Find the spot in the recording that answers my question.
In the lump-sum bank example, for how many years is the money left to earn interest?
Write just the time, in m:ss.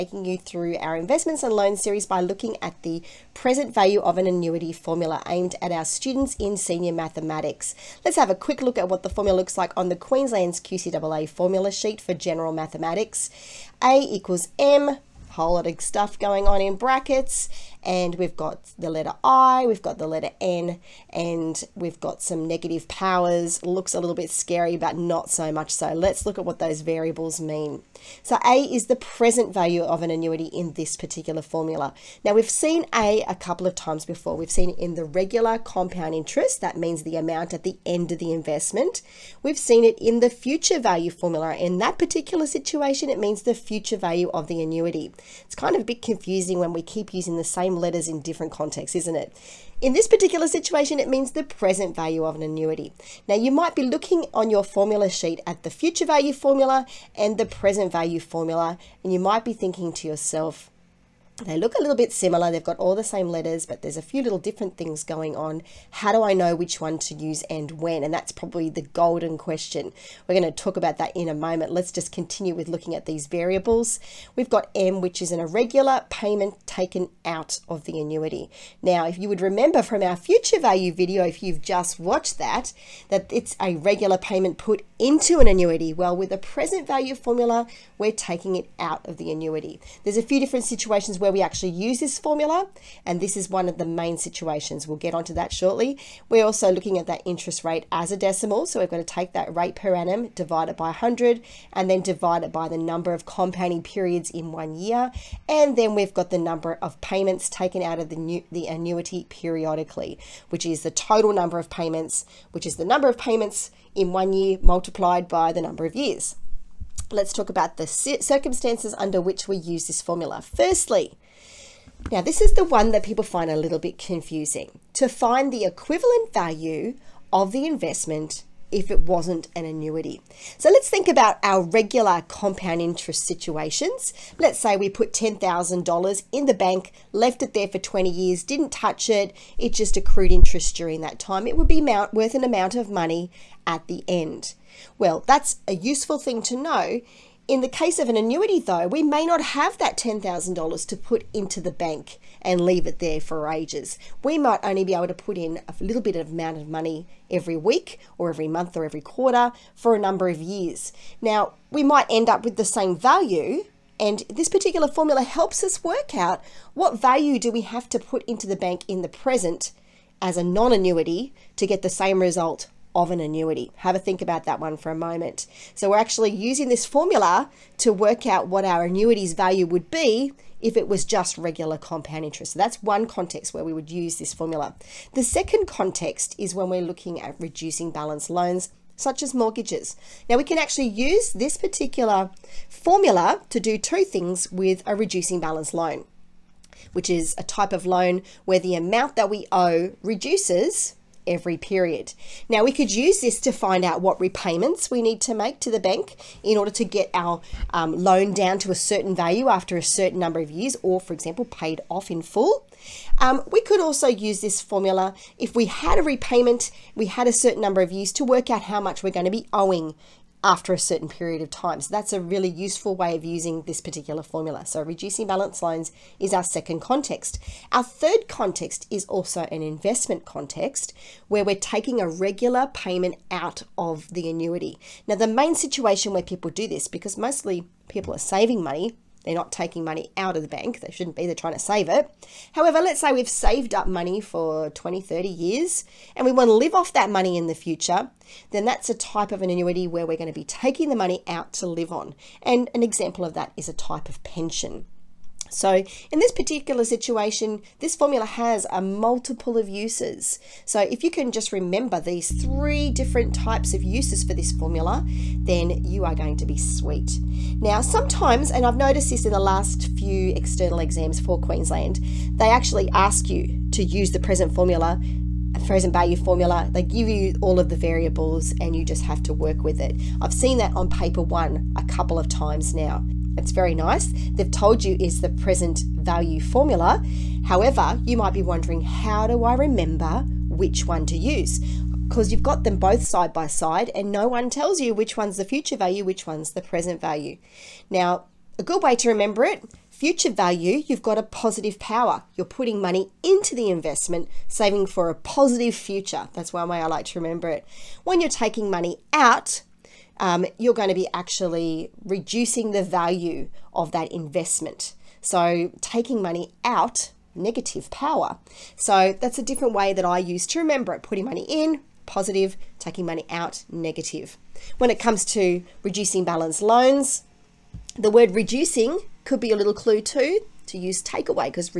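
2:17.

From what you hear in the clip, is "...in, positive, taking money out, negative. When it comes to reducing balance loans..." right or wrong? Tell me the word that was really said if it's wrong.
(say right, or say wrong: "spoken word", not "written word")
right.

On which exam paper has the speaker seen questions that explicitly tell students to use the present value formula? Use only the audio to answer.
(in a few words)
Paper one.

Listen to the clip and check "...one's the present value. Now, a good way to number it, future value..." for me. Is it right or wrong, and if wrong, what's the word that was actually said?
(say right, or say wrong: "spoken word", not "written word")
wrong: "remember", not "number".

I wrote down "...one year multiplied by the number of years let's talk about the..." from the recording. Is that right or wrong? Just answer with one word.
right.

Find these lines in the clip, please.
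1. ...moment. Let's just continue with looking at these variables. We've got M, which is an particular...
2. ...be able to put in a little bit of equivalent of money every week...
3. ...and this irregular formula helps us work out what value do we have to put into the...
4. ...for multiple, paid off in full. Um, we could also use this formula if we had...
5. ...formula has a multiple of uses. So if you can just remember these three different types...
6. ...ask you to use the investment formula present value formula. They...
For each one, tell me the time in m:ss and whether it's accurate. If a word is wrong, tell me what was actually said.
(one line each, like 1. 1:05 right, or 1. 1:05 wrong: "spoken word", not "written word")
1. 1:11 wrong: "irregular", not "particular"
2. 2:34 wrong: "amount", not "equivalent"
3. 2:43 wrong: "particular", not "irregular"
4. 3:31 wrong: "example", not "multiple"
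5. 4:17 right
6. 4:32 wrong: "present", not "investment".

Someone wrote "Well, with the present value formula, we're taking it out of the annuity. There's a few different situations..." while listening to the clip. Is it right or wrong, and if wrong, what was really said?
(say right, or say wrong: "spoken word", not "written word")
right.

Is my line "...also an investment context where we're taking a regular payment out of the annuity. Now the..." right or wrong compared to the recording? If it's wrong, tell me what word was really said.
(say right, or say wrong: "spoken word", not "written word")
right.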